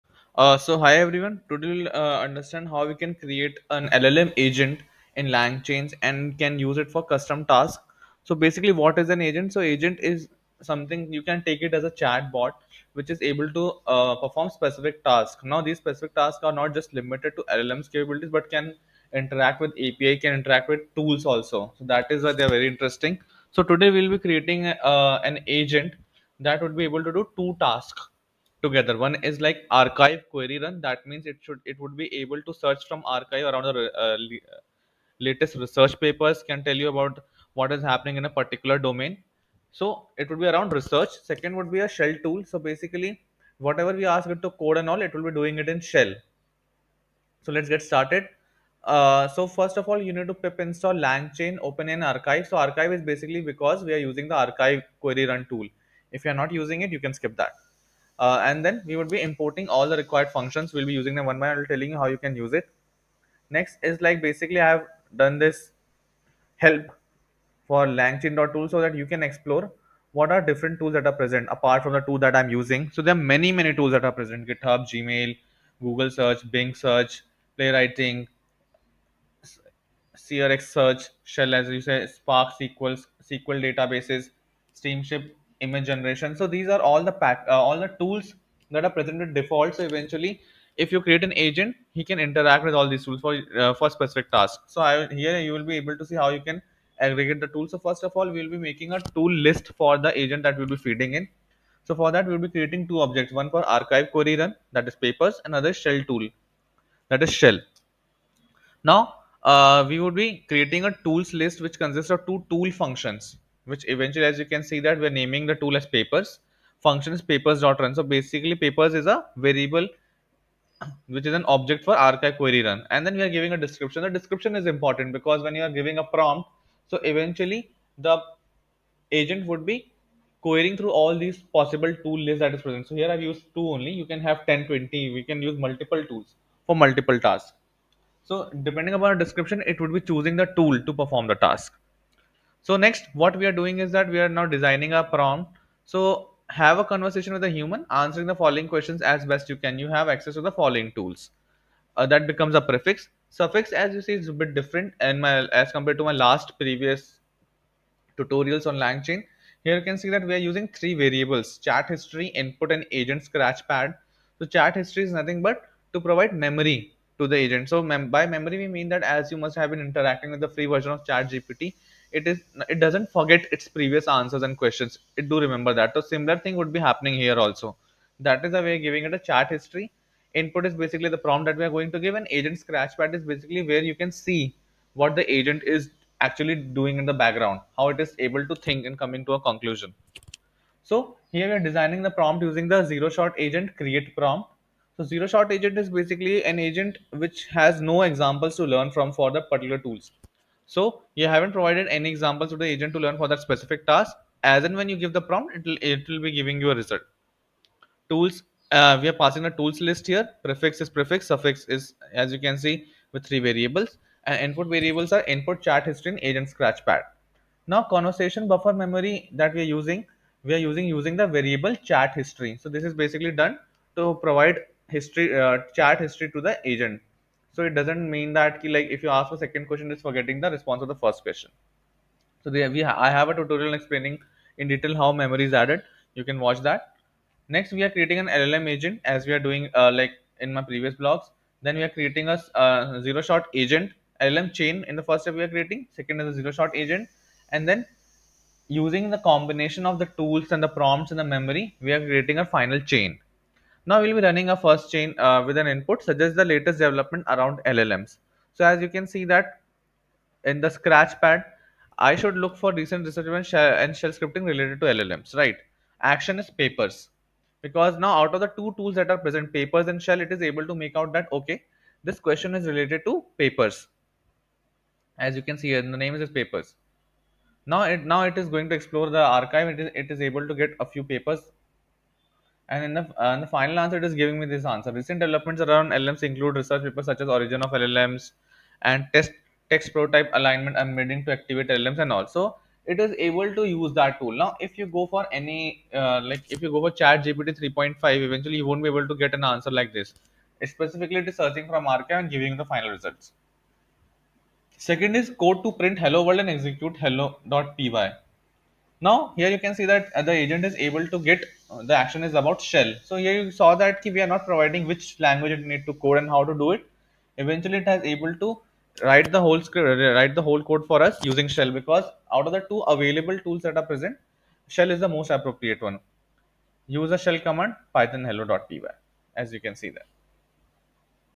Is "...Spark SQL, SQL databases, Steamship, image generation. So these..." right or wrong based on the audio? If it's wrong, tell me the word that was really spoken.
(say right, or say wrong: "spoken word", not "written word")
right.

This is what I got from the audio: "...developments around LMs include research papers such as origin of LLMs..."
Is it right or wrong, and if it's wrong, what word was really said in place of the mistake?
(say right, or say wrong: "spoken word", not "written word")
right.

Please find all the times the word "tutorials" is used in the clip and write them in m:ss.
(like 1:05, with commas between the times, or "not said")
2:38, 3:53.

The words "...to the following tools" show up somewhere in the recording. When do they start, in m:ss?
2:30.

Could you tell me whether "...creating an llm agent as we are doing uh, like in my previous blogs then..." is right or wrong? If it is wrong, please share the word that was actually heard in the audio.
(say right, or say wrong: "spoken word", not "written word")
right.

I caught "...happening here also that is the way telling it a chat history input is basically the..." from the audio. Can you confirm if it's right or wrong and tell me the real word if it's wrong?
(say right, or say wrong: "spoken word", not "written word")
wrong: "giving", not "telling".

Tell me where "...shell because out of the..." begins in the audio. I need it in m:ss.
5:21.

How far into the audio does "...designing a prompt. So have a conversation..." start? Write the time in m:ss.
2:24.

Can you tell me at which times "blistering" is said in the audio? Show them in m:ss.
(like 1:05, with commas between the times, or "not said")
not said.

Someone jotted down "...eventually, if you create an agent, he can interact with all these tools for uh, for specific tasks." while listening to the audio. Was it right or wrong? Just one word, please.
right.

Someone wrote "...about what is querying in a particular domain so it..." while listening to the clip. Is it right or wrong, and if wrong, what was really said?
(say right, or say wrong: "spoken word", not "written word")
wrong: "happening", not "querying".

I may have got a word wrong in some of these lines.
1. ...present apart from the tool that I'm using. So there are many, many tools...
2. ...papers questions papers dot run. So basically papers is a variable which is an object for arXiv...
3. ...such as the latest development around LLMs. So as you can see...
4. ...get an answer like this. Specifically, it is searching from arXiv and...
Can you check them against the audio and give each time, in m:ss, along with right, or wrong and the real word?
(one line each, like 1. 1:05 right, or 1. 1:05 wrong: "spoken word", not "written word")
1. 1:11 right
2. 1:55 wrong: "functions", not "questions"
3. 4:16 right
4. 4:59 right.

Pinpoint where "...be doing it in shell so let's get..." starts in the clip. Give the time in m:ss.
0:45.